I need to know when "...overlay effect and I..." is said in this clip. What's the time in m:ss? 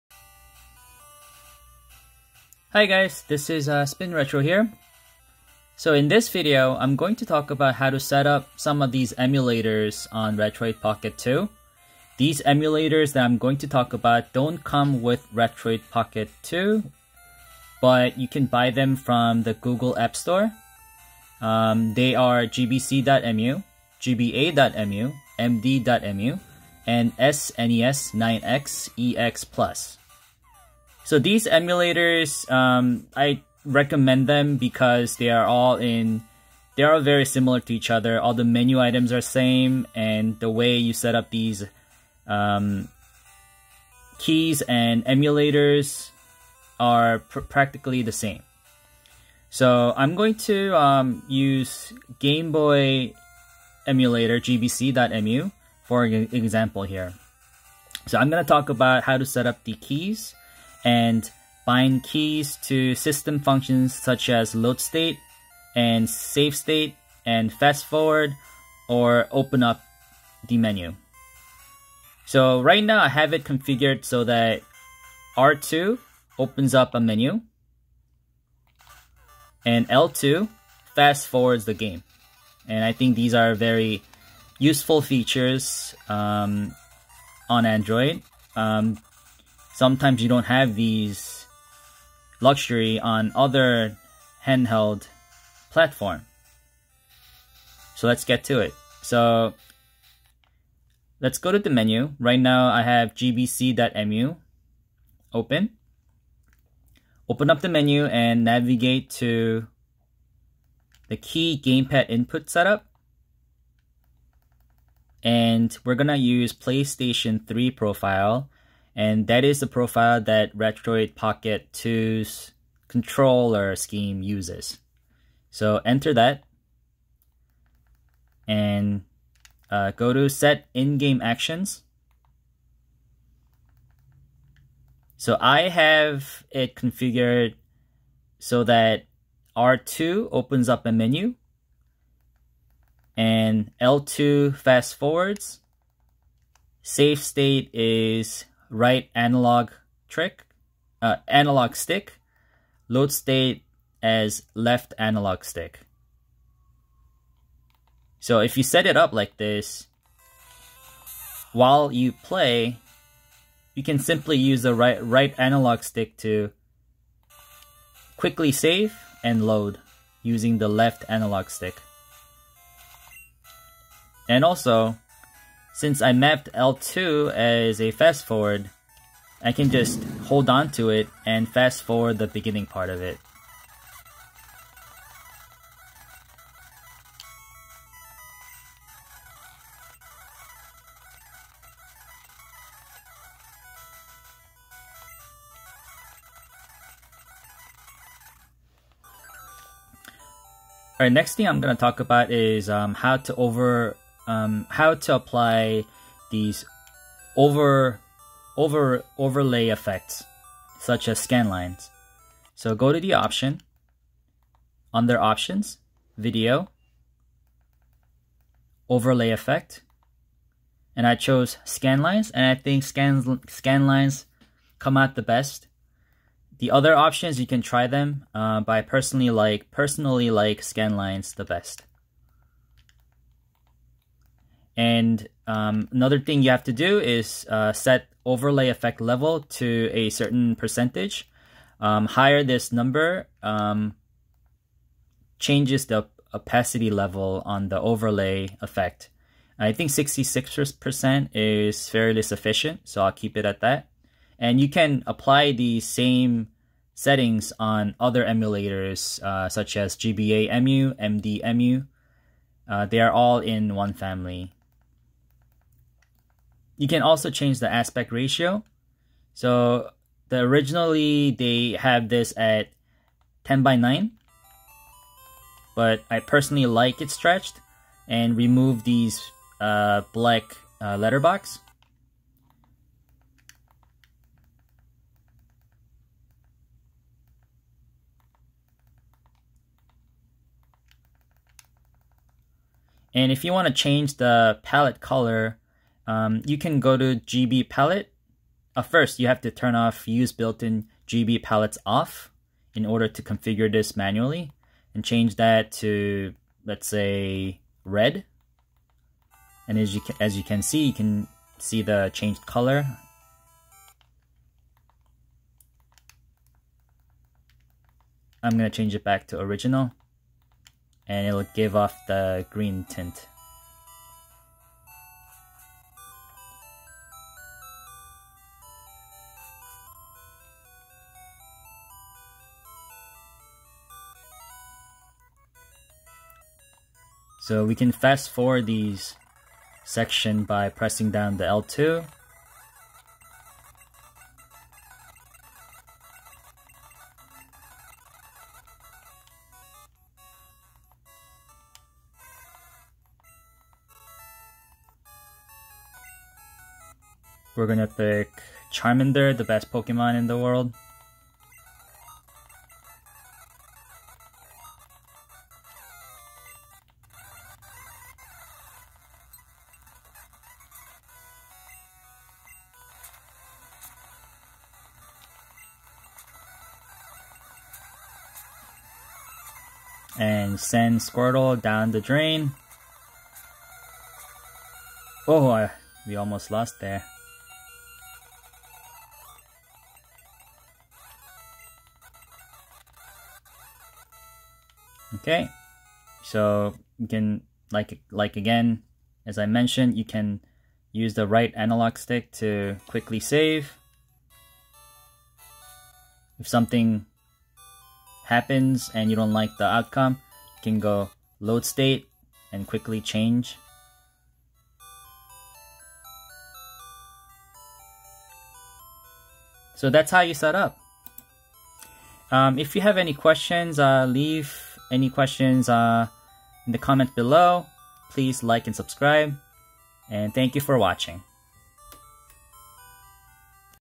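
3:38.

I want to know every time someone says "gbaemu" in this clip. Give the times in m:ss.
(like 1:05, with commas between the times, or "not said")
0:23, 4:19.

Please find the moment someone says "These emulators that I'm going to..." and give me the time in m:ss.
0:12.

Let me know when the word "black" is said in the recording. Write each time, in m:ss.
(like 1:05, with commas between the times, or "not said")
4:40.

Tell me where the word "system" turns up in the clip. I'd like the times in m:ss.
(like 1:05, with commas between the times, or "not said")
1:02.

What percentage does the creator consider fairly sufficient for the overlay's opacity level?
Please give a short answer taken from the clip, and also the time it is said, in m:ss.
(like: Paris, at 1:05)
66%, at 4:09.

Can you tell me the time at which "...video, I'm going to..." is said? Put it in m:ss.
0:06.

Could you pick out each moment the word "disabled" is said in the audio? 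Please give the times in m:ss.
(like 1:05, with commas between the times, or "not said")
not said.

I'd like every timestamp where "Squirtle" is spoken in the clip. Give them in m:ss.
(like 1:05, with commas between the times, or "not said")
6:20.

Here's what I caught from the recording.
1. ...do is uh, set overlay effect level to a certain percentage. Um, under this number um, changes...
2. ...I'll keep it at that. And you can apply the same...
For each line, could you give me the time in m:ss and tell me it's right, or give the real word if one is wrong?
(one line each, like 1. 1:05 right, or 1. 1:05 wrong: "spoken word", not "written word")
1. 3:56 wrong: "higher", not "under"
2. 4:13 right.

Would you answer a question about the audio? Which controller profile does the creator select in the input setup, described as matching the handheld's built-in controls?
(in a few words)
PlayStation 3.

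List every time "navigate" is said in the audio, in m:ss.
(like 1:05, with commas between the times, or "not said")
1:48.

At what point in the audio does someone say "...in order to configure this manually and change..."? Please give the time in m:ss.
5:02.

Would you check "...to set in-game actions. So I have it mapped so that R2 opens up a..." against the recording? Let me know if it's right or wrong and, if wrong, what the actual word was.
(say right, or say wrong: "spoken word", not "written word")
wrong: "configured", not "mapped".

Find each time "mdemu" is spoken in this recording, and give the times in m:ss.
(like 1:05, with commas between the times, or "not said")
0:25, 4:20.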